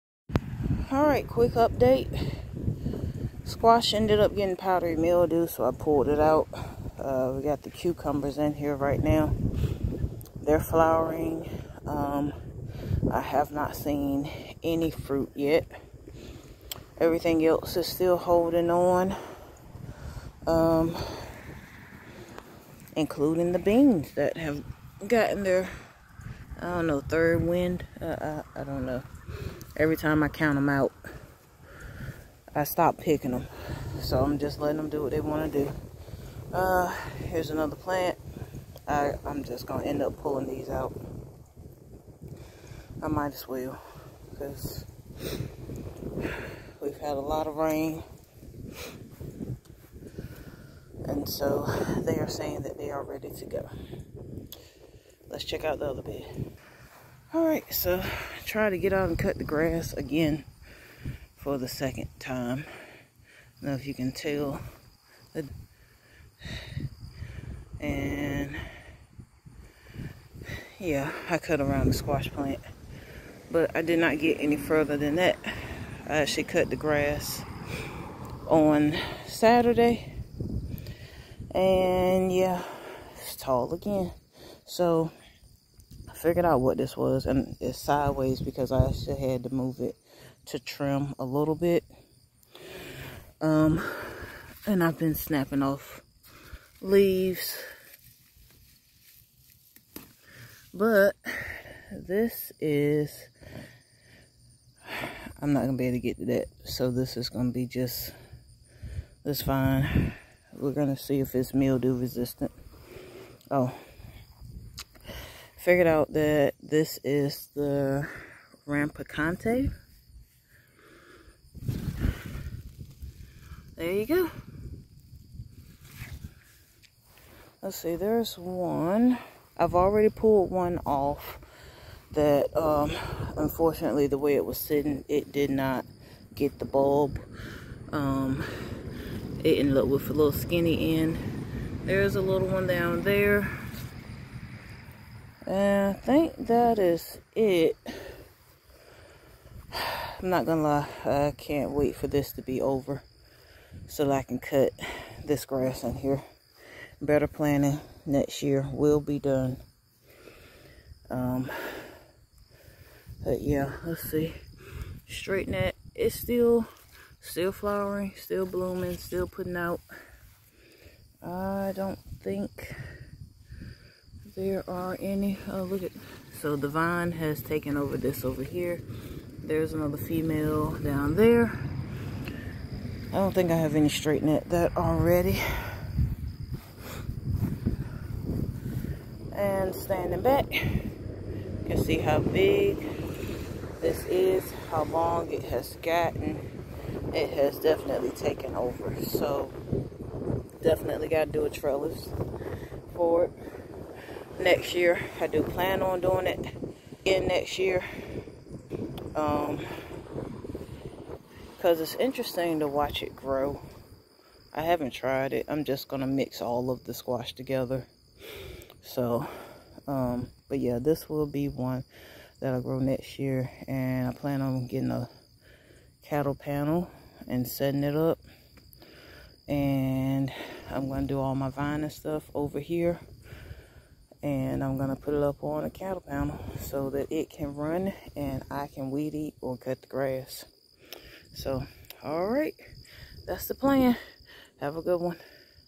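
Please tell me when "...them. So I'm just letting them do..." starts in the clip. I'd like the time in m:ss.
0:33.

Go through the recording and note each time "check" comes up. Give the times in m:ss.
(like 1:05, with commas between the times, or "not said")
0:55.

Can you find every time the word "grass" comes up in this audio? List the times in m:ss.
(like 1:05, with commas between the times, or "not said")
0:59, 1:16, 2:35, 3:59.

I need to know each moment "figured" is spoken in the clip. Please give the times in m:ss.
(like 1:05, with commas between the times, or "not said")
1:26, 1:55.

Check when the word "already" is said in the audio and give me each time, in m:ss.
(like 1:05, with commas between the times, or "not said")
2:09, 3:04.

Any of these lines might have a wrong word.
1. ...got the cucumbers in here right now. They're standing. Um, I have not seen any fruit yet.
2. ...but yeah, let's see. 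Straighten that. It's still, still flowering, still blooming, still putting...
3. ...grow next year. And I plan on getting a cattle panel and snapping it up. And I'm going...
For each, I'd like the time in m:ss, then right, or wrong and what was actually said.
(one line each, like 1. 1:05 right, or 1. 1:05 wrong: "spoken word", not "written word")
1. 0:07 wrong: "flowering", not "standing"
2. 2:43 right
3. 3:42 wrong: "setting", not "snapping".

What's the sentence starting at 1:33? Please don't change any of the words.
Um, and I've been snapping off leaves.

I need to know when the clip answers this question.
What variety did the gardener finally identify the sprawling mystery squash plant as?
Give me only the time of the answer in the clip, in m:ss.
1:58.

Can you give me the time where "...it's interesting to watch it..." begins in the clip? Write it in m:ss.
3:31.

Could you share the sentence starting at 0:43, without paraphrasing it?
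I might as well because we've had a lot of rain.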